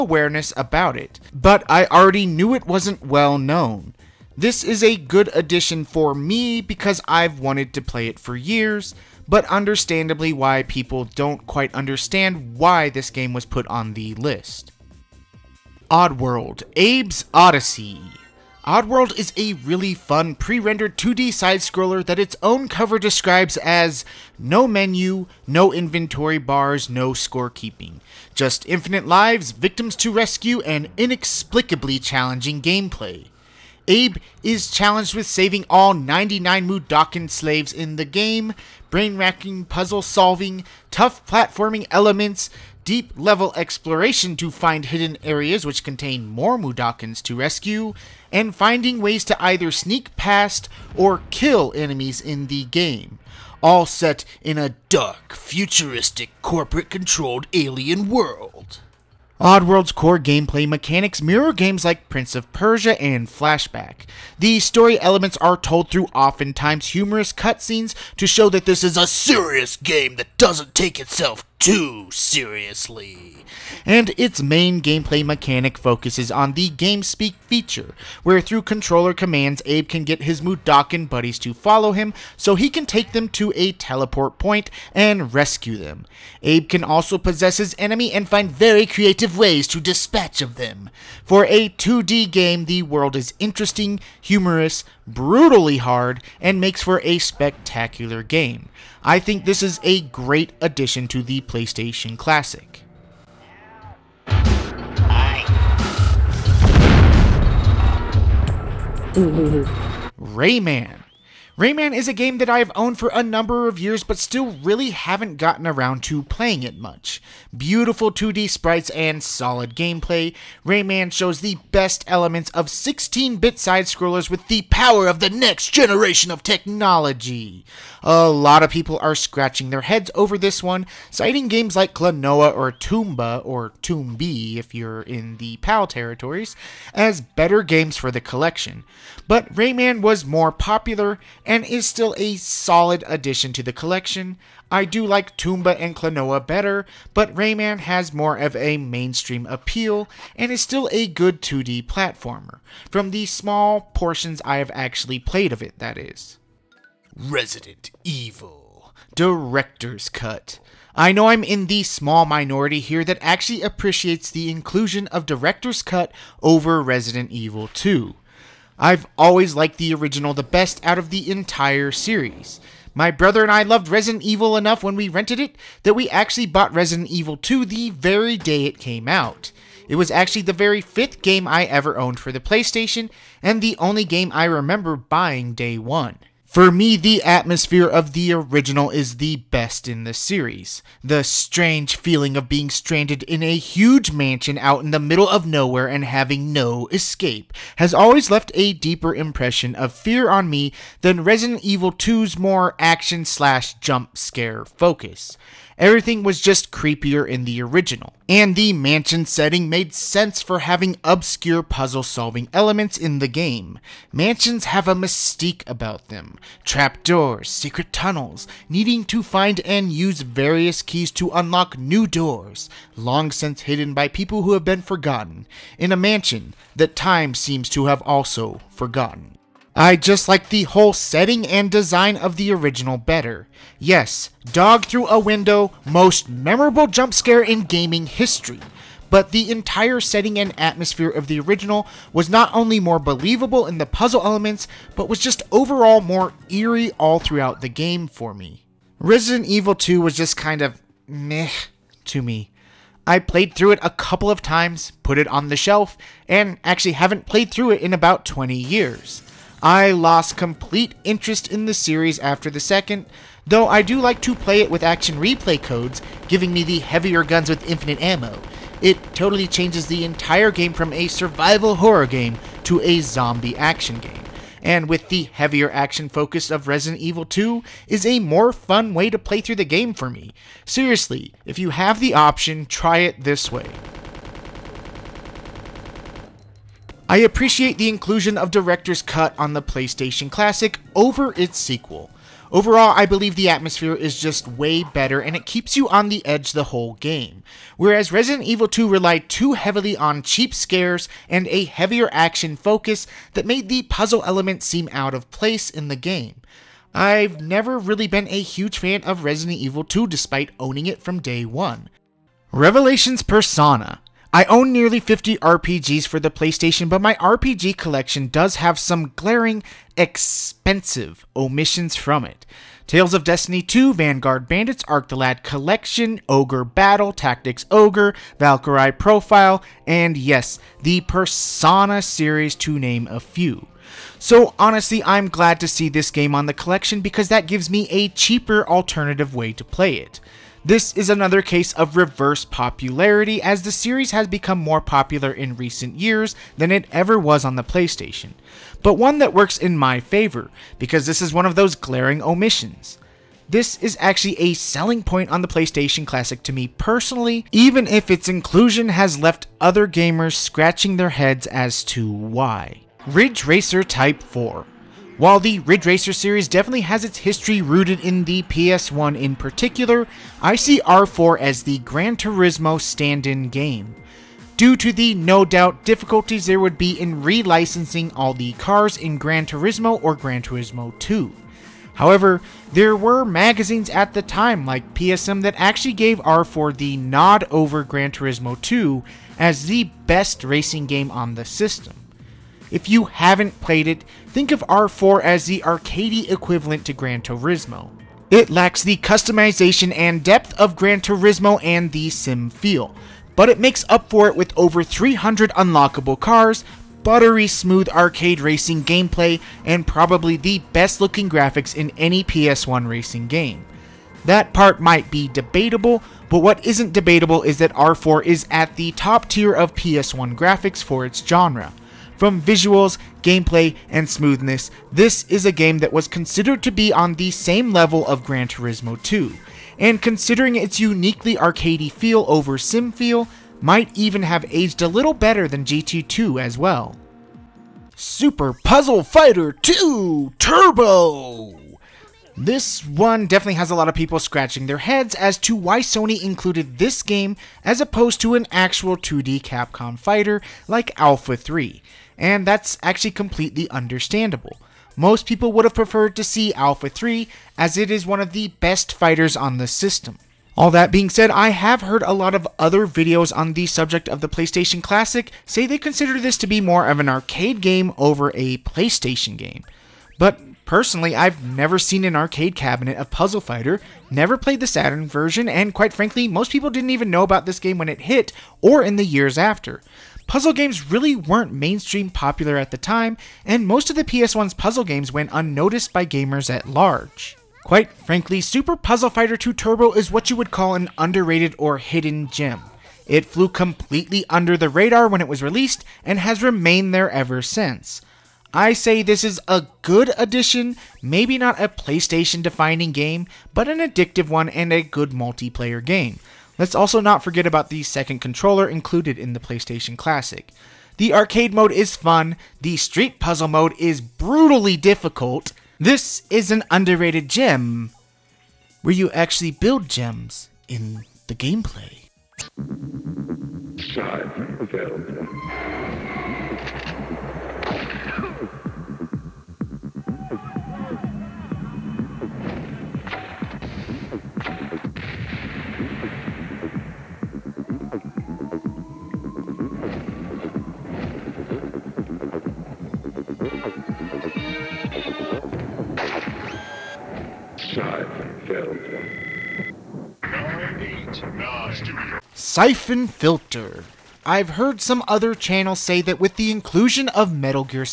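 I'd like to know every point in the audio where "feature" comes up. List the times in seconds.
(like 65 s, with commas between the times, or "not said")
77 s.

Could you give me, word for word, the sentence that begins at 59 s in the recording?
Oddworld's core gameplay mechanics mirror games like Prince of Persia and Flashback.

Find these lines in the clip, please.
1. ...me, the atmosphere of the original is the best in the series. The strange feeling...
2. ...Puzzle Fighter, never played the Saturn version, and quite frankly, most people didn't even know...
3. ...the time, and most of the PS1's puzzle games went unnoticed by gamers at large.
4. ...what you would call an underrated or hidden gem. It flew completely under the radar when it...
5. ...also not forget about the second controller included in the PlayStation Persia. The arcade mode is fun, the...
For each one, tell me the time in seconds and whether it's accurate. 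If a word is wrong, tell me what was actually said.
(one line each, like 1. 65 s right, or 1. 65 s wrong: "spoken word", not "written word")
1. 186 s right
2. 473 s right
3. 482 s right
4. 490 s right
5. 506 s wrong: "Classic", not "Persia".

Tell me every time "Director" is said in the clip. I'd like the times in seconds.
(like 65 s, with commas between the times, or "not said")
159 s, 165 s, 288 s.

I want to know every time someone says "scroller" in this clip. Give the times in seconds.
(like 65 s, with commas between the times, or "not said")
21 s, 123 s.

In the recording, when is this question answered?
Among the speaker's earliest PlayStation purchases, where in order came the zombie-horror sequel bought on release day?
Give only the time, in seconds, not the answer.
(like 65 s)
180 s.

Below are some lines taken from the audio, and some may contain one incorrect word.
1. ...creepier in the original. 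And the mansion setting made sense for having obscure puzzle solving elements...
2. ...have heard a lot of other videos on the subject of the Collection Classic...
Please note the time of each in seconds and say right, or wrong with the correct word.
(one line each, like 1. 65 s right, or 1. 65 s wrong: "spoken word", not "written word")
1. 206 s right
2. 461 s wrong: "PlayStation", not "Collection".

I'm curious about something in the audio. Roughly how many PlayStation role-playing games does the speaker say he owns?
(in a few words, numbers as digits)
nearly 50.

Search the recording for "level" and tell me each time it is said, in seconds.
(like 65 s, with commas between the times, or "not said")
43 s, 427 s.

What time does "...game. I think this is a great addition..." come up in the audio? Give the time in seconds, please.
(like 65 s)
98 s.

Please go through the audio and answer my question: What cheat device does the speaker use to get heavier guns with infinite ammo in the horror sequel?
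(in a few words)
Action Replay.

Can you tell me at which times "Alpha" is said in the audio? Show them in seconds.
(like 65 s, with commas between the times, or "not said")
451 s, 456 s.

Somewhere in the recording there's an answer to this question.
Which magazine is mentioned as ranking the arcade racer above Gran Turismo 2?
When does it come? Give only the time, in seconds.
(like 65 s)
384 s.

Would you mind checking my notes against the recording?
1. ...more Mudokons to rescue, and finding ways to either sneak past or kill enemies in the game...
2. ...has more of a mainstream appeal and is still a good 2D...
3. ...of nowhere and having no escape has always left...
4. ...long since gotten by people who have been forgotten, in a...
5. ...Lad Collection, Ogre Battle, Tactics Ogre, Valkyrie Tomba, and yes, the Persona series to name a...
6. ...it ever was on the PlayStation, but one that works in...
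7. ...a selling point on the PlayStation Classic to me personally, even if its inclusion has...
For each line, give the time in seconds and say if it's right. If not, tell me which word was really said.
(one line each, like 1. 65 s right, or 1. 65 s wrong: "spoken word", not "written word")
1. 46 s right
2. 147 s right
3. 195 s right
4. 222 s wrong: "hidden", not "gotten"
5. 325 s wrong: "Profile", not "Tomba"
6. 346 s right
7. 354 s right.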